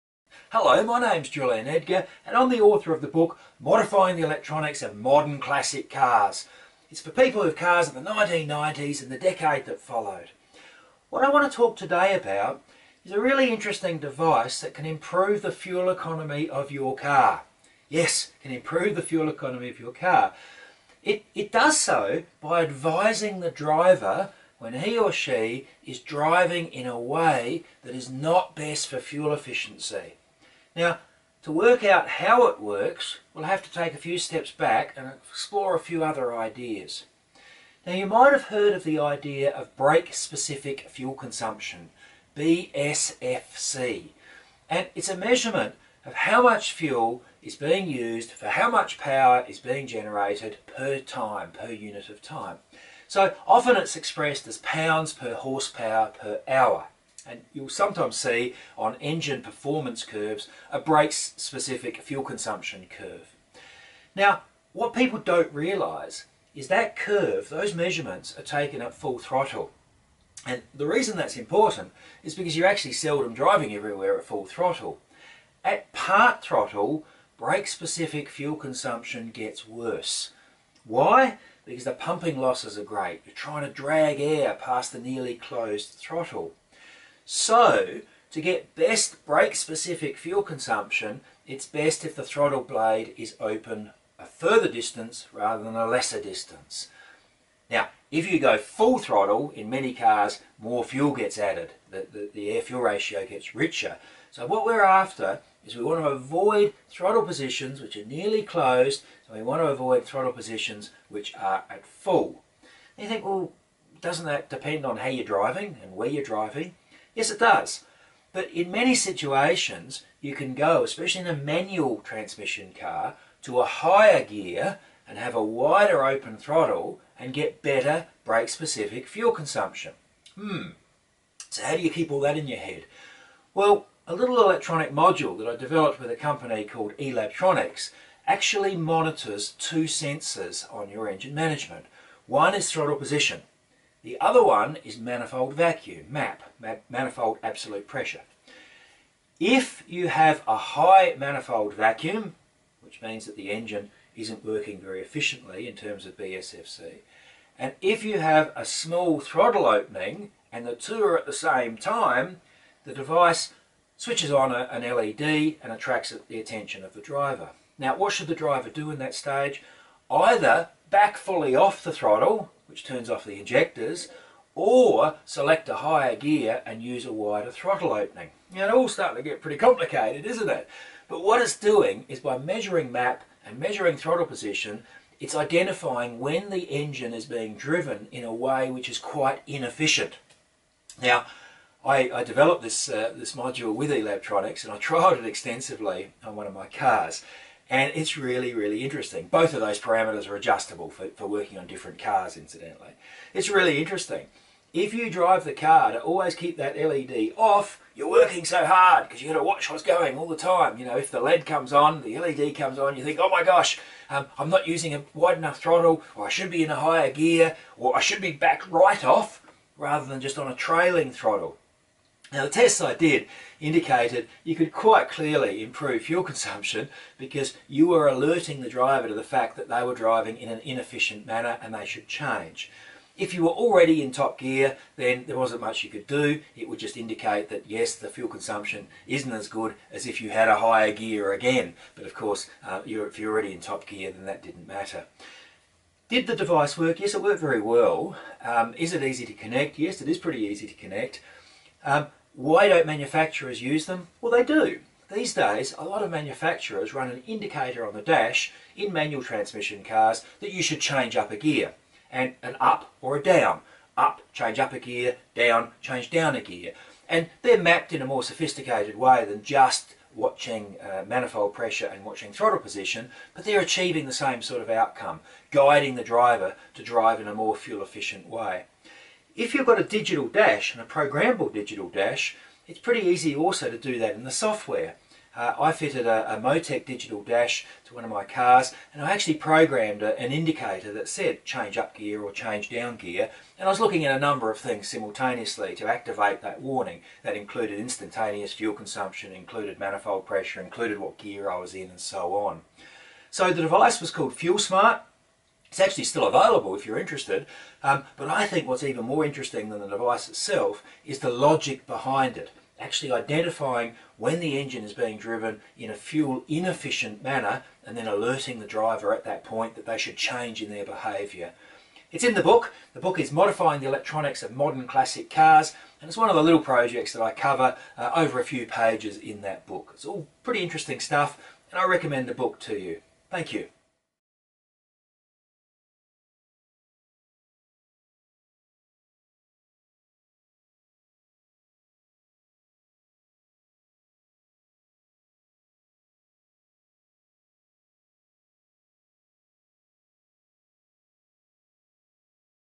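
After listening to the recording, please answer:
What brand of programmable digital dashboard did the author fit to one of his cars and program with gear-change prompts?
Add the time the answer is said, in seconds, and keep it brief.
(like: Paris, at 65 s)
Motec, at 286 s.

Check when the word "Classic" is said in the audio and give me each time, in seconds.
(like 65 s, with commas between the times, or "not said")
5 s, 324 s.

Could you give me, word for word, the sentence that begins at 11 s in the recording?
What I want to talk today about is a really interesting device that can improve the fuel economy of your car.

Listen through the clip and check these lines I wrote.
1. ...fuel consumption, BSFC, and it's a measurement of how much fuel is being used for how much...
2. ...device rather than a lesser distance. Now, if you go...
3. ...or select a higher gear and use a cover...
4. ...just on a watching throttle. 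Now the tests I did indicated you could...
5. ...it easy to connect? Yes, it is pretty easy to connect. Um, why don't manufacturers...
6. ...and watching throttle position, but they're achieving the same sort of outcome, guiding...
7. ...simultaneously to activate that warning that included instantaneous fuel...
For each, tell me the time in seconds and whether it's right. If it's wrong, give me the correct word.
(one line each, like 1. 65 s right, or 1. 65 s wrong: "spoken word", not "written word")
1. 40 s right
2. 94 s wrong: "distance", not "device"
3. 174 s wrong: "wider", not "cover"
4. 220 s wrong: "trailing", not "watching"
5. 248 s right
6. 271 s right
7. 294 s right.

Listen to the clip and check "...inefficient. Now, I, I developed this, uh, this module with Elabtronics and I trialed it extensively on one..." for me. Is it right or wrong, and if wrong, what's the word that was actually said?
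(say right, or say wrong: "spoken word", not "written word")
right.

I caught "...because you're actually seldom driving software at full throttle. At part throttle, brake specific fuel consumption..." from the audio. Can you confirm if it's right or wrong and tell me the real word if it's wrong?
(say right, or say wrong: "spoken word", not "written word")
wrong: "everywhere", not "software".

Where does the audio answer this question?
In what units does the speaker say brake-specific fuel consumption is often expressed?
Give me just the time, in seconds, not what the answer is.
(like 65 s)
54 s.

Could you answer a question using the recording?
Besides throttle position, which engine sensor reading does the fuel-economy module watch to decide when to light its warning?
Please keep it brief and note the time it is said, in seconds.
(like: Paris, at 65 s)
manifold absolute pressure, at 146 s.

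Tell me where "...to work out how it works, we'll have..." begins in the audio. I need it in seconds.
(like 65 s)
31 s.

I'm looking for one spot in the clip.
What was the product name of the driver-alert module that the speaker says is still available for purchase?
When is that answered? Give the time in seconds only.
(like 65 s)
304 s.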